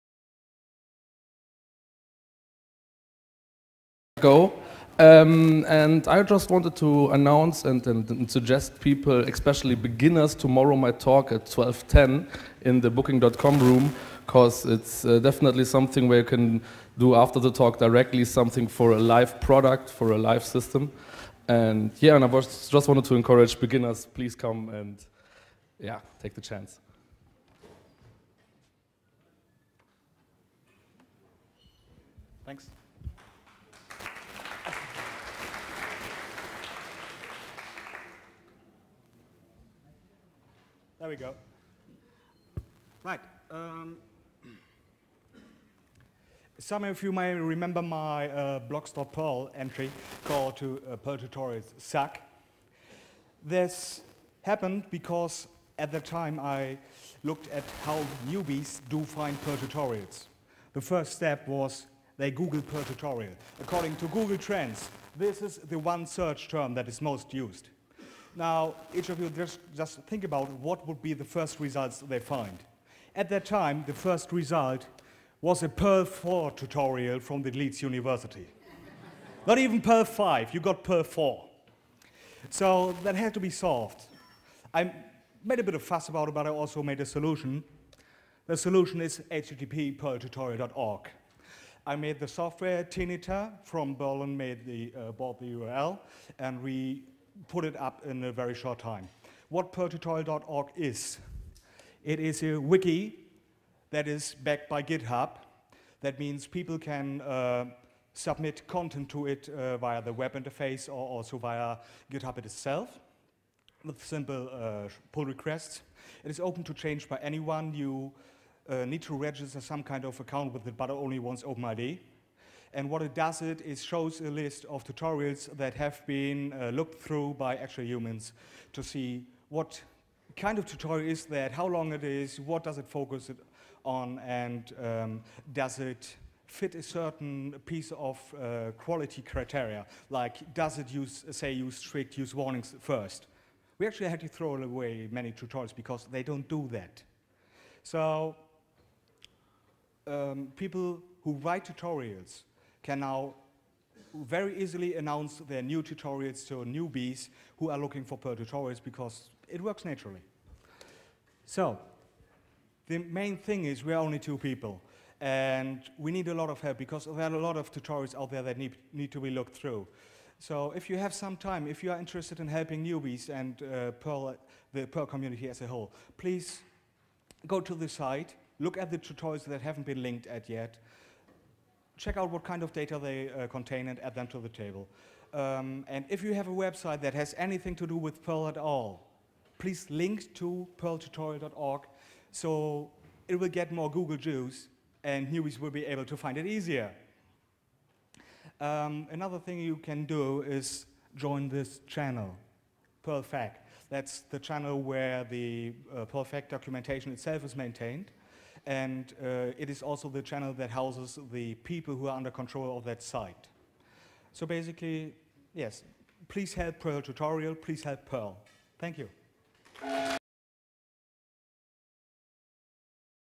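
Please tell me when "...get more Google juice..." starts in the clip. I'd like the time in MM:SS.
03:13.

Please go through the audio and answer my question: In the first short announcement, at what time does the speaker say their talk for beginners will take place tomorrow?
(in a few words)
12:10.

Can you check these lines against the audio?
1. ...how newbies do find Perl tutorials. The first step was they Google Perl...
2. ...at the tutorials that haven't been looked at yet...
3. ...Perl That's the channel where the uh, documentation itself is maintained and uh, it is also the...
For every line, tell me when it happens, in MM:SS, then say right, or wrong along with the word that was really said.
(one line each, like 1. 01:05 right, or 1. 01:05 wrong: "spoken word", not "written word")
1. 00:57 right
2. 02:58 wrong: "linked", not "looked"
3. 03:23 right.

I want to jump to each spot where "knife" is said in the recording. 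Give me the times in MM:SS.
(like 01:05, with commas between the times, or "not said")
not said.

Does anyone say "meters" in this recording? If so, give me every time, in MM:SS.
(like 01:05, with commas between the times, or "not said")
not said.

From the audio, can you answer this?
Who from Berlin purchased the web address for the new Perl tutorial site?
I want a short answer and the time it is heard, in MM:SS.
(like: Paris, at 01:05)
Tinita, at 01:32.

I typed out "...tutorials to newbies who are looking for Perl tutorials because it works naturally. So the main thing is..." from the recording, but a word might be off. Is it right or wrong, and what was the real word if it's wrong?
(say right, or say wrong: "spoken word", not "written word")
right.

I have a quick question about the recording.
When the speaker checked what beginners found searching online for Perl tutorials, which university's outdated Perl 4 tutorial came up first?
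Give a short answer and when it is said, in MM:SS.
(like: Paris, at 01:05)
Leeds University, at 01:17.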